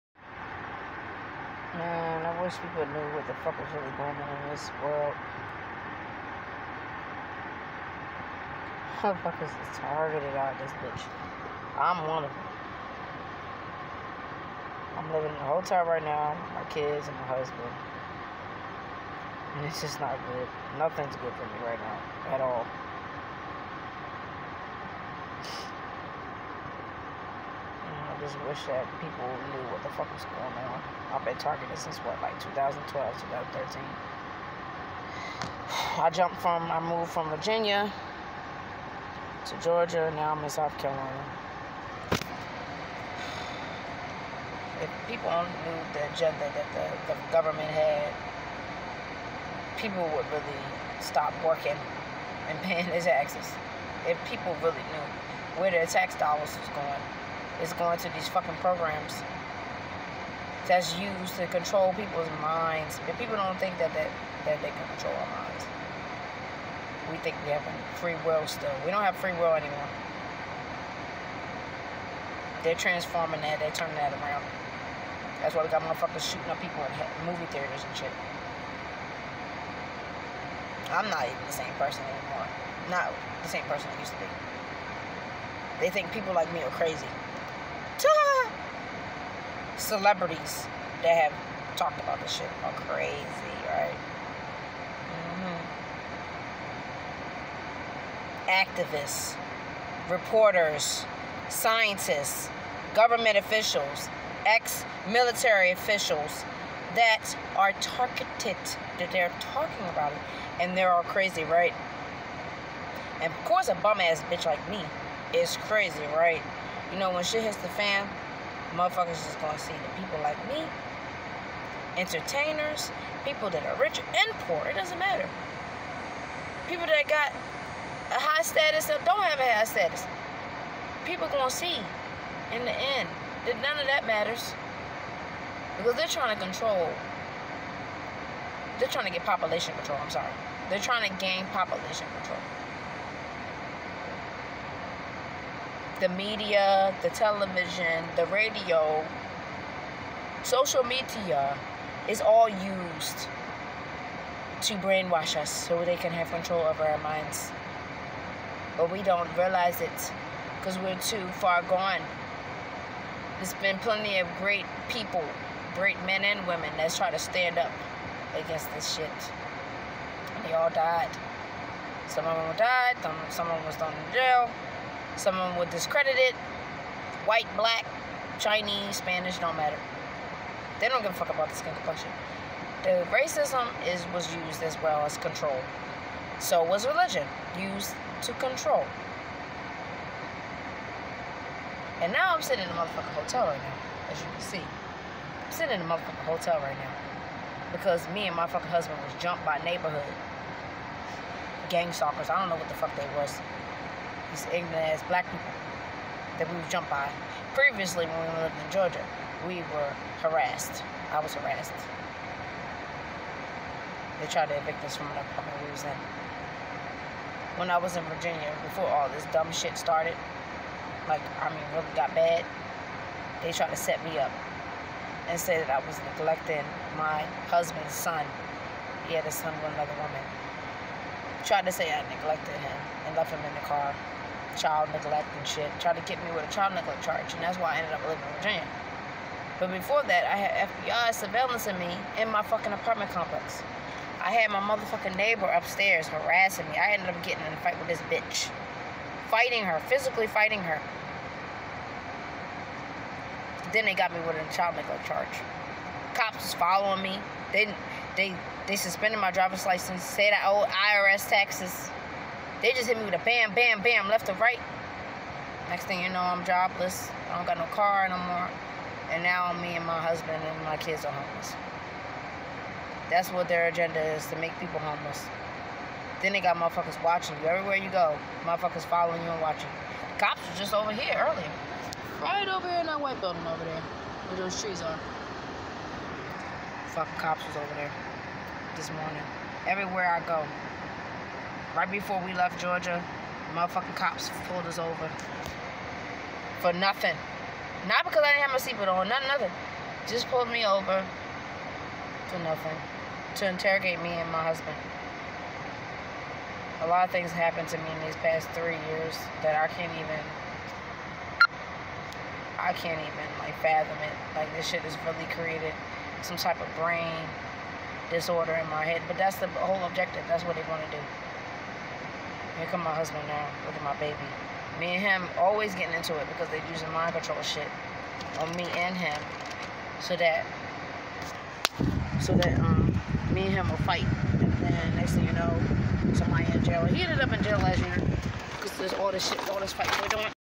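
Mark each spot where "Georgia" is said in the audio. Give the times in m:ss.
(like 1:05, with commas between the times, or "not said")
0:39, 3:28, 4:52.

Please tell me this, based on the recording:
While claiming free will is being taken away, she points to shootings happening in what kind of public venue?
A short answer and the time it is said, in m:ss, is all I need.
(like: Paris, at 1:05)
Movie theaters, at 1:17.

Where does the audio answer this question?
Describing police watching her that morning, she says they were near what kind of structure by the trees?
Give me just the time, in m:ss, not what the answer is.
4:43.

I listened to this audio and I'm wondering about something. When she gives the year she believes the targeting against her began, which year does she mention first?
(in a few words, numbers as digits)
2012.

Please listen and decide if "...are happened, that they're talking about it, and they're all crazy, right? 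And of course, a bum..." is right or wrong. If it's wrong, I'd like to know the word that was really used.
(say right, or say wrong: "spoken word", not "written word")
wrong: "targeted", not "happened".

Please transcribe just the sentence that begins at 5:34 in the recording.
And then next thing you know, somebody in jail.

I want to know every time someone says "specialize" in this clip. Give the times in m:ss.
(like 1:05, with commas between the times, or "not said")
not said.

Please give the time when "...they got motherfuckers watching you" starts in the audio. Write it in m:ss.
4:36.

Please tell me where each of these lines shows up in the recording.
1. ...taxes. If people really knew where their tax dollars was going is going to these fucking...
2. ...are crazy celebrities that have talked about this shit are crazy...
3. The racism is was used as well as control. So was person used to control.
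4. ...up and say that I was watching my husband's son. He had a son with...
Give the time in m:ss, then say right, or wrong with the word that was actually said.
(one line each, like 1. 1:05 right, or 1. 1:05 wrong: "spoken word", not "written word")
1. 0:53 right
2. 1:26 right
3. 3:02 wrong: "religion", not "person"
4. 3:44 wrong: "neglecting", not "watching".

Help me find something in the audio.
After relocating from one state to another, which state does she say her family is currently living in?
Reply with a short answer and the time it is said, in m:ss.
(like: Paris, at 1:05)
South Carolina, at 0:40.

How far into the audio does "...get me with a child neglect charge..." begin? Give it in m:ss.
3:56.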